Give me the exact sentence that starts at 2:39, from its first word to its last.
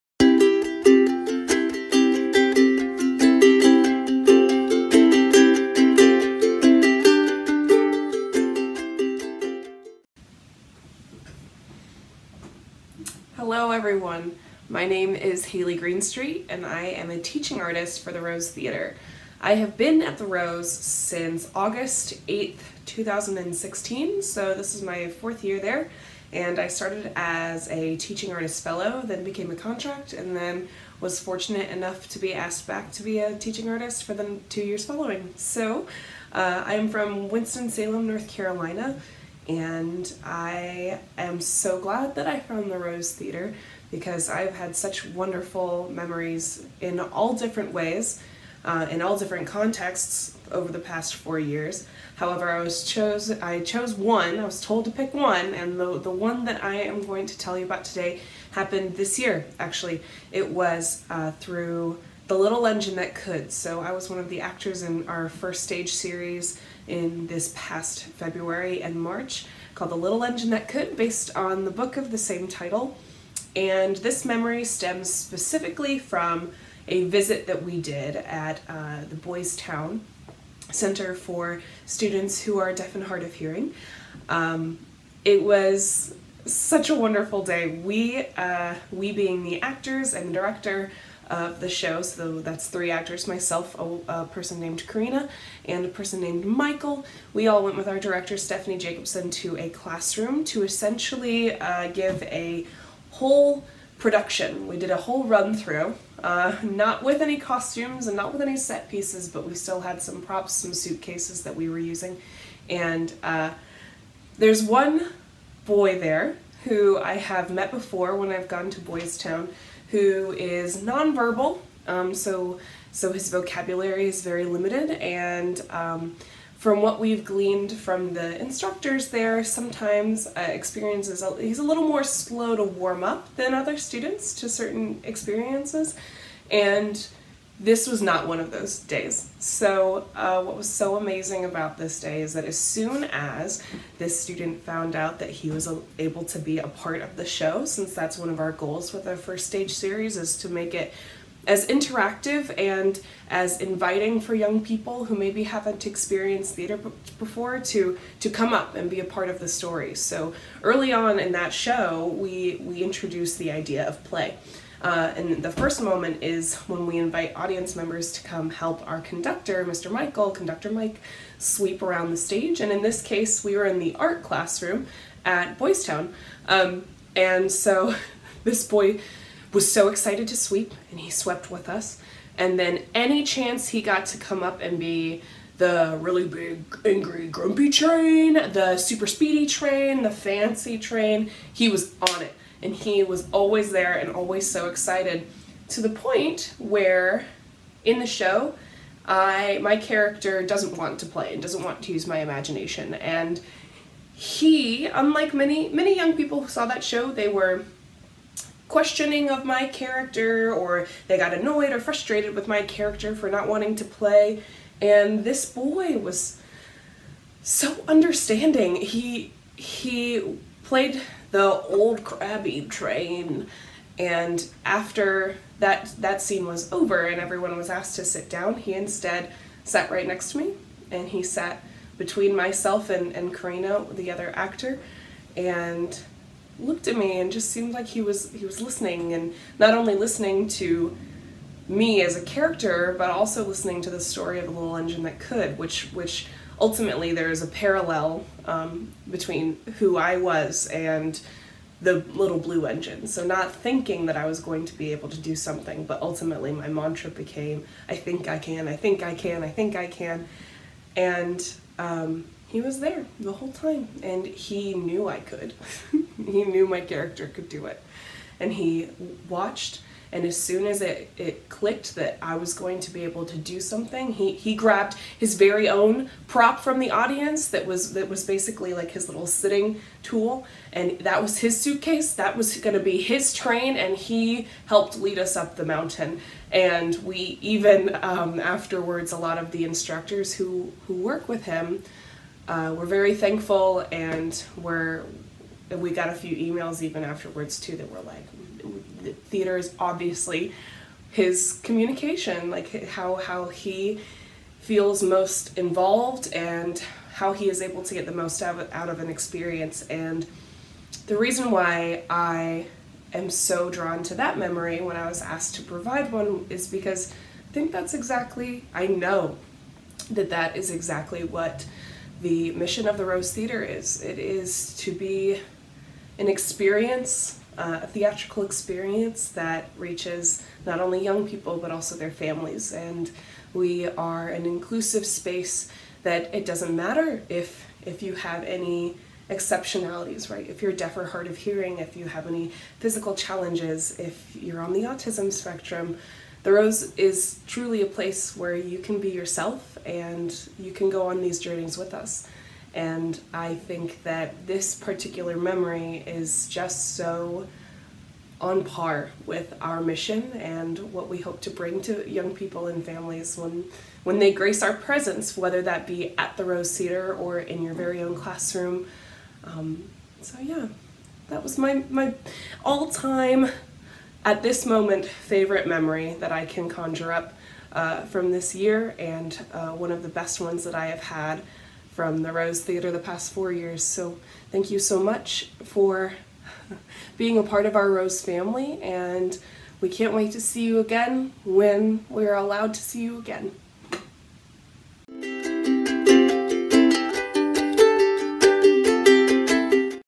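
So early on in that show, we we introduced the idea of play.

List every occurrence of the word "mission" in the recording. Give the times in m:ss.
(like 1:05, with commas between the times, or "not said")
5:22, 5:59.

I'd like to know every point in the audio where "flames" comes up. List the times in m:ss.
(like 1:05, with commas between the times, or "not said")
not said.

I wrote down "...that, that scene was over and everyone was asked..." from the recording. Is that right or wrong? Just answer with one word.
right.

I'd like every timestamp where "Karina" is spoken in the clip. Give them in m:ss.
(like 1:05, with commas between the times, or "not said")
1:34, 3:53.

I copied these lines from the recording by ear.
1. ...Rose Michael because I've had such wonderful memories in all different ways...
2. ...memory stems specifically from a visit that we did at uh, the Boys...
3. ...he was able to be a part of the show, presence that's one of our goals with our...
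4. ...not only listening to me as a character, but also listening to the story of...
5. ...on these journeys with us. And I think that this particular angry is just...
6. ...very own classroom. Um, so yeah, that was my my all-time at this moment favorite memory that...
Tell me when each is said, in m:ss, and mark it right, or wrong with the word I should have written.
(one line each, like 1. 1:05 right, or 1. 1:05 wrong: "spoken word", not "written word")
1. 0:42 wrong: "Theater", not "Michael"
2. 1:14 right
3. 2:25 wrong: "since", not "presence"
4. 3:59 right
5. 5:51 wrong: "memory", not "angry"
6. 6:07 right.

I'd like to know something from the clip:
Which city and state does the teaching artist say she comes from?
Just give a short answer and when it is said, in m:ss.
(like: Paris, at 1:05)
Winston-Salem, North Carolina, at 0:37.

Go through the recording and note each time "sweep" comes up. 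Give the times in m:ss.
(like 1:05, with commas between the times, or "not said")
2:51, 3:00.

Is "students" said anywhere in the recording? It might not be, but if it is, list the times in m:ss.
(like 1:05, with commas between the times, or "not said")
1:21, 2:13, 2:24.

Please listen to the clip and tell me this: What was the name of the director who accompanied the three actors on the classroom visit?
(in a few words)
Stephanie Jacobson.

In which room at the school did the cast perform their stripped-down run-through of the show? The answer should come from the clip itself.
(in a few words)
the art classroom.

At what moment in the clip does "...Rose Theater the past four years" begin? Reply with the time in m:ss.
6:22.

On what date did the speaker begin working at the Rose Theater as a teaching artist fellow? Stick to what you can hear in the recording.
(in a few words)
August 8th, 2016.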